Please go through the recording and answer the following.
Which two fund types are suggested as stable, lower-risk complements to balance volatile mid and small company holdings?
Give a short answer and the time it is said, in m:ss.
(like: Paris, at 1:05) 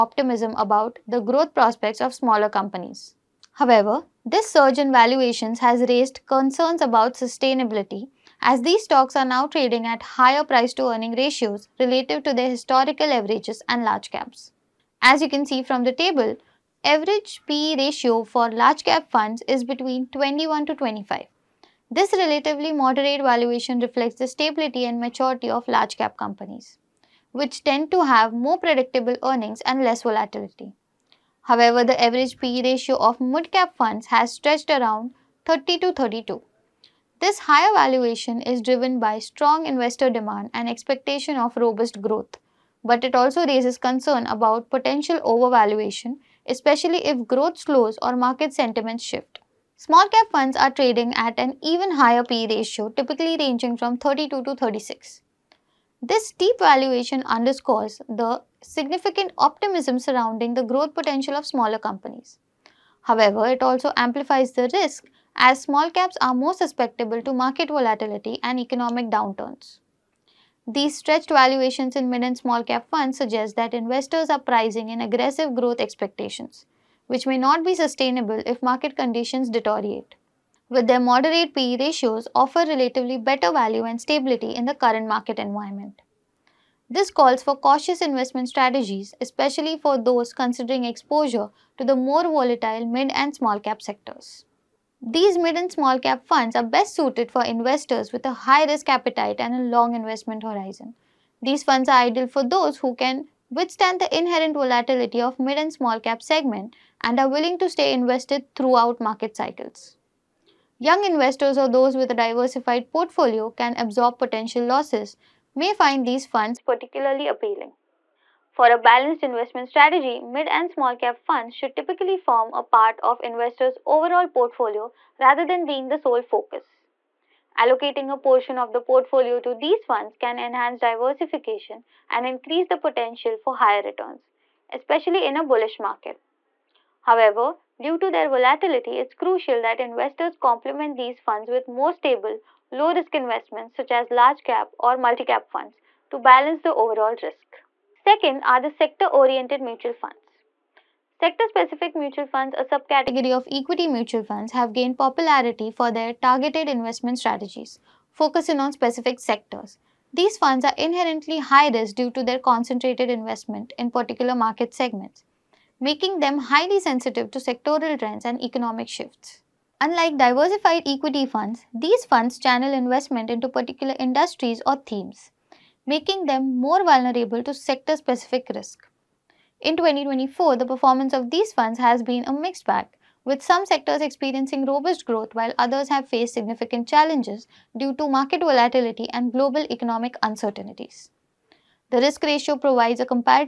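large cap or multi cap, at 2:24.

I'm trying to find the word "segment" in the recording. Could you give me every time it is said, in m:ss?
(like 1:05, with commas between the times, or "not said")
1:46, 2:44.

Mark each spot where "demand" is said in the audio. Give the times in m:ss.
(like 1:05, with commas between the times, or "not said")
0:40.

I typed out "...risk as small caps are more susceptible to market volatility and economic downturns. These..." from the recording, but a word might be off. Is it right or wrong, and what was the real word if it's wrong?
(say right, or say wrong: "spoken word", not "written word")
right.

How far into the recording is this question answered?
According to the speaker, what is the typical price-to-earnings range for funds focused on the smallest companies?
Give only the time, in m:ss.
0:53.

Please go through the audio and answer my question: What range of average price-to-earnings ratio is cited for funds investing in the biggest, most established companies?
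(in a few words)
21 to 25.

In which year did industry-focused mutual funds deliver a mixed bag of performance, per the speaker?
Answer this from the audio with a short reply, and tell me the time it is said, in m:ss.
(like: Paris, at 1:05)
2024, at 2:59.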